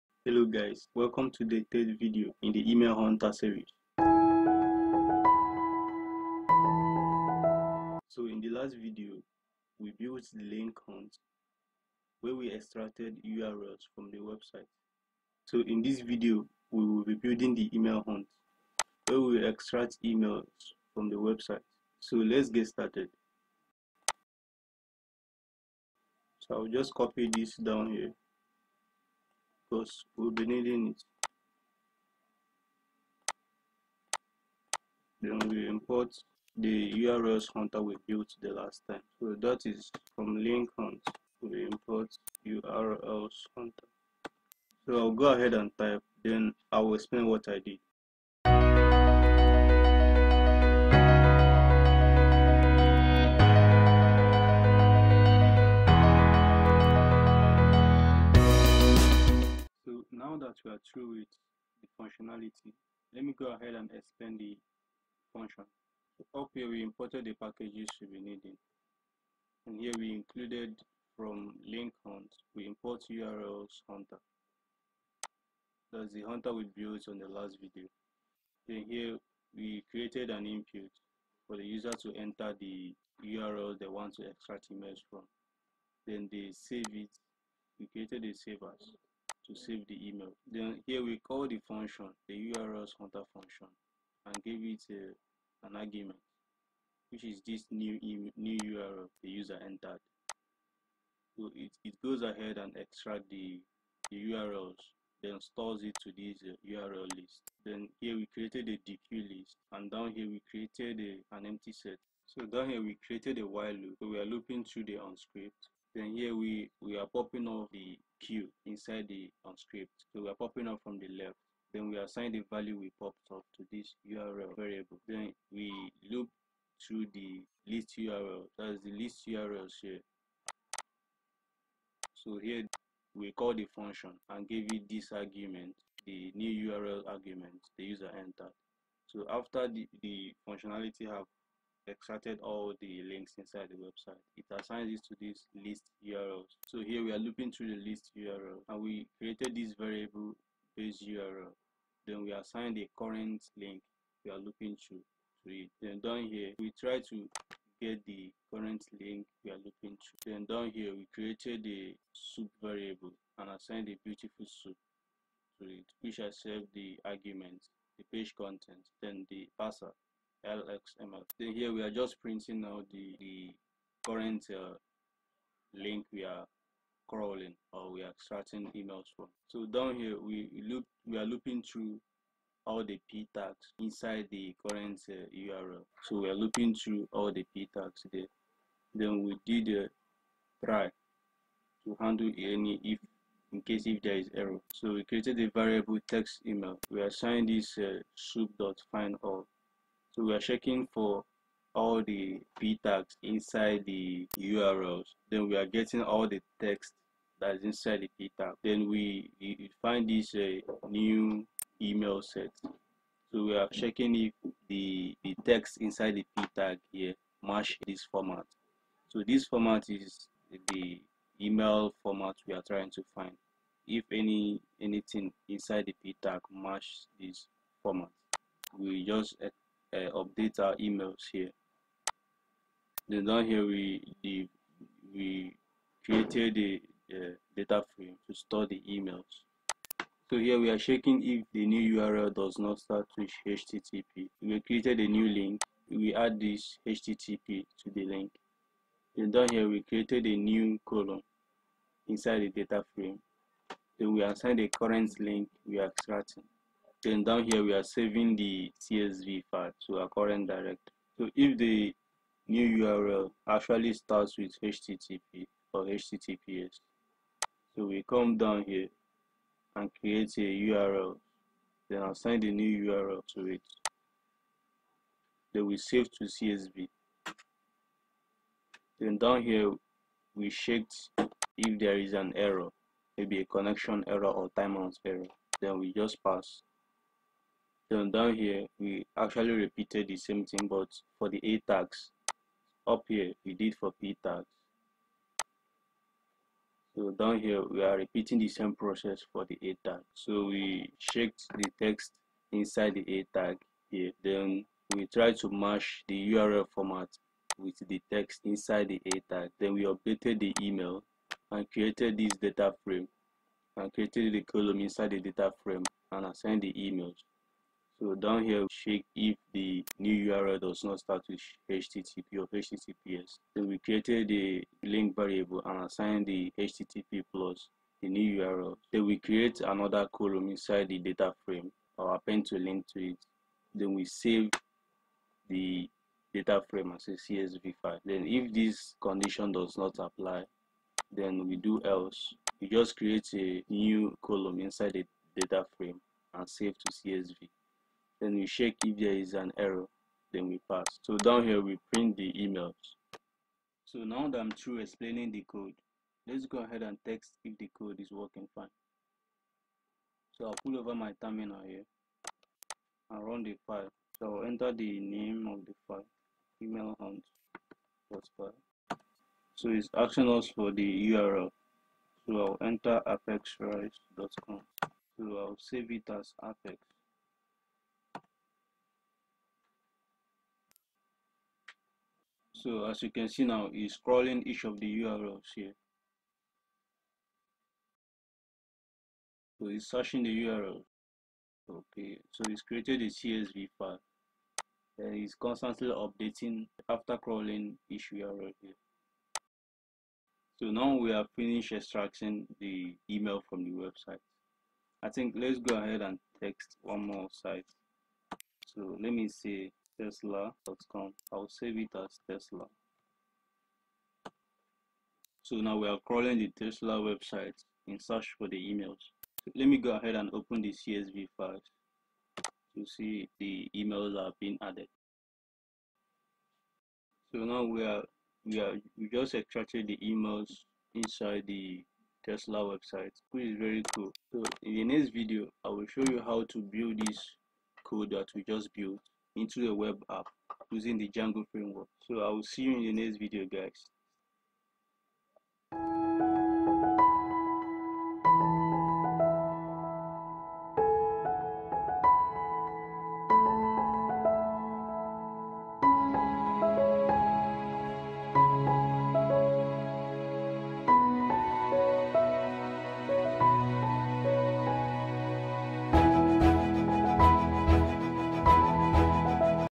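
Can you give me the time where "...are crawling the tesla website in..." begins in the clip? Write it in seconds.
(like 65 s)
415 s.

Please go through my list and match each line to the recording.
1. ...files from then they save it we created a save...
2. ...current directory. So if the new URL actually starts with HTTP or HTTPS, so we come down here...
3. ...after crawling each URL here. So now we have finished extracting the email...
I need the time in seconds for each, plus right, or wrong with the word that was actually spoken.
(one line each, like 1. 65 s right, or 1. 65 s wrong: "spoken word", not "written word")
1. 84 s wrong: "images", not "files"
2. 260 s right
3. 396 s right.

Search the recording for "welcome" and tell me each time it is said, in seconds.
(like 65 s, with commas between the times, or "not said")
0 s.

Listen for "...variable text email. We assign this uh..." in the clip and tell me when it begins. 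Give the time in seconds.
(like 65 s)
195 s.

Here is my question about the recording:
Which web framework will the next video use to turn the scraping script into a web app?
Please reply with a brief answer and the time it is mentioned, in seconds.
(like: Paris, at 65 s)
Django, at 441 s.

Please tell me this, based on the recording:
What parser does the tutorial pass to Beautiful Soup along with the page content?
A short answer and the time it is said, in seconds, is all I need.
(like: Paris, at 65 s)
LXML, at 170 s.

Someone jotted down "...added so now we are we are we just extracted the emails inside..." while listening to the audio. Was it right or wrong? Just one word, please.
right.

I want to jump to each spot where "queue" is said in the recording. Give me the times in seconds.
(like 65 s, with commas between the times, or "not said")
118 s.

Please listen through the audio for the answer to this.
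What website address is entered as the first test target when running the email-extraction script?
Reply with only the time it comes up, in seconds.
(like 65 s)
373 s.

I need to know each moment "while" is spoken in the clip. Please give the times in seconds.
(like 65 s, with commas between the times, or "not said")
113 s.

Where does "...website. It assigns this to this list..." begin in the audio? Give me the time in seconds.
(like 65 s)
143 s.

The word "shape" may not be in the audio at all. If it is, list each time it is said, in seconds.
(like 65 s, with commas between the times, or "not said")
not said.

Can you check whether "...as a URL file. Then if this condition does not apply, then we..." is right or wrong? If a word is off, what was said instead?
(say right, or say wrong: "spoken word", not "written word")
wrong: "CSV", not "URL".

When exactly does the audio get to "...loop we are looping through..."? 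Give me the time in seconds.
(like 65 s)
180 s.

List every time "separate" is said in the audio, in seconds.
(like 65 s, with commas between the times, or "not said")
not said.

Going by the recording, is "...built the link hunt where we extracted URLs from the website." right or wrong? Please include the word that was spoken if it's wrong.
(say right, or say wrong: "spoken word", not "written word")
right.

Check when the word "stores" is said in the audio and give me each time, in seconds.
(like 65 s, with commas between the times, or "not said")
105 s, 238 s.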